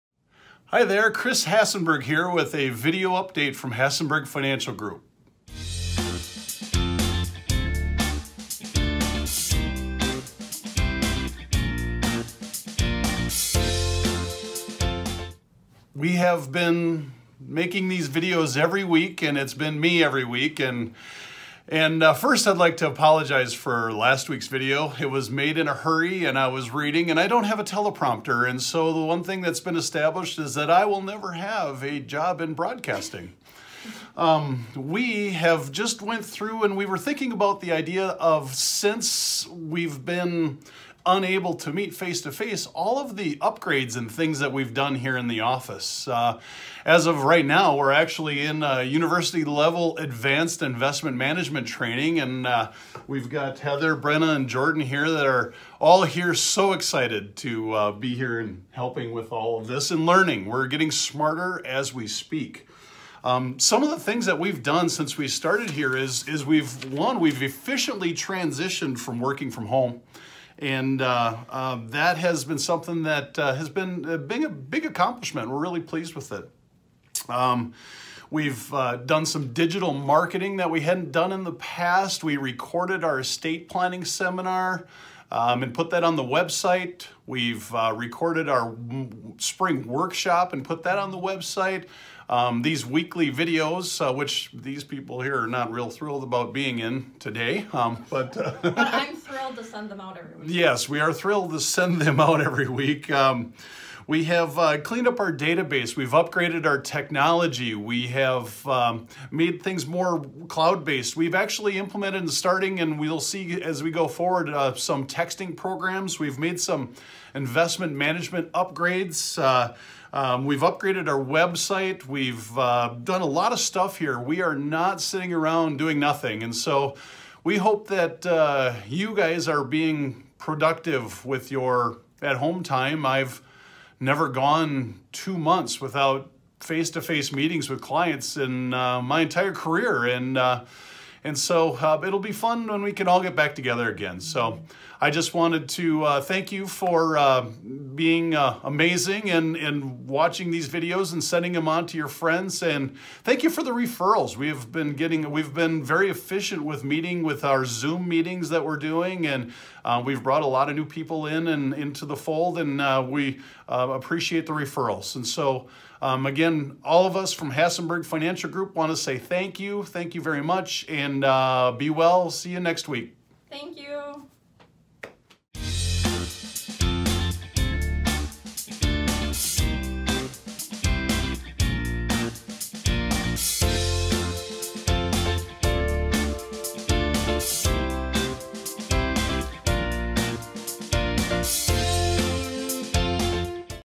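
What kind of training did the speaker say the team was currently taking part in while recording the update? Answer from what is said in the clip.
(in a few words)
advanced investment management training.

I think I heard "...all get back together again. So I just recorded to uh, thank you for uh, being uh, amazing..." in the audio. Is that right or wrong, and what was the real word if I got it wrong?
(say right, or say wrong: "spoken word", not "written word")
wrong: "wanted", not "recorded".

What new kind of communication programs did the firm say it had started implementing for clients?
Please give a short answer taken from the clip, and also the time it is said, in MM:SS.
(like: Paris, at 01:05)
texting programs, at 01:55.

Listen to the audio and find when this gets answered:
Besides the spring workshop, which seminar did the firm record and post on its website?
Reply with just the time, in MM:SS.
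01:23.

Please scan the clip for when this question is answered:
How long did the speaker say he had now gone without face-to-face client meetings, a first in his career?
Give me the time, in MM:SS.
02:15.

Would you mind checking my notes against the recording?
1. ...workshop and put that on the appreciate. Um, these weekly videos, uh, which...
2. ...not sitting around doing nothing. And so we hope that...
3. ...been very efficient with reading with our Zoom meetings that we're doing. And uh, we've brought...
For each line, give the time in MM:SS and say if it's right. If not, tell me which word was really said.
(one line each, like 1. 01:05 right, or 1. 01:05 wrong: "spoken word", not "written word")
1. 01:29 wrong: "website", not "appreciate"
2. 02:04 right
3. 02:35 wrong: "meeting", not "reading".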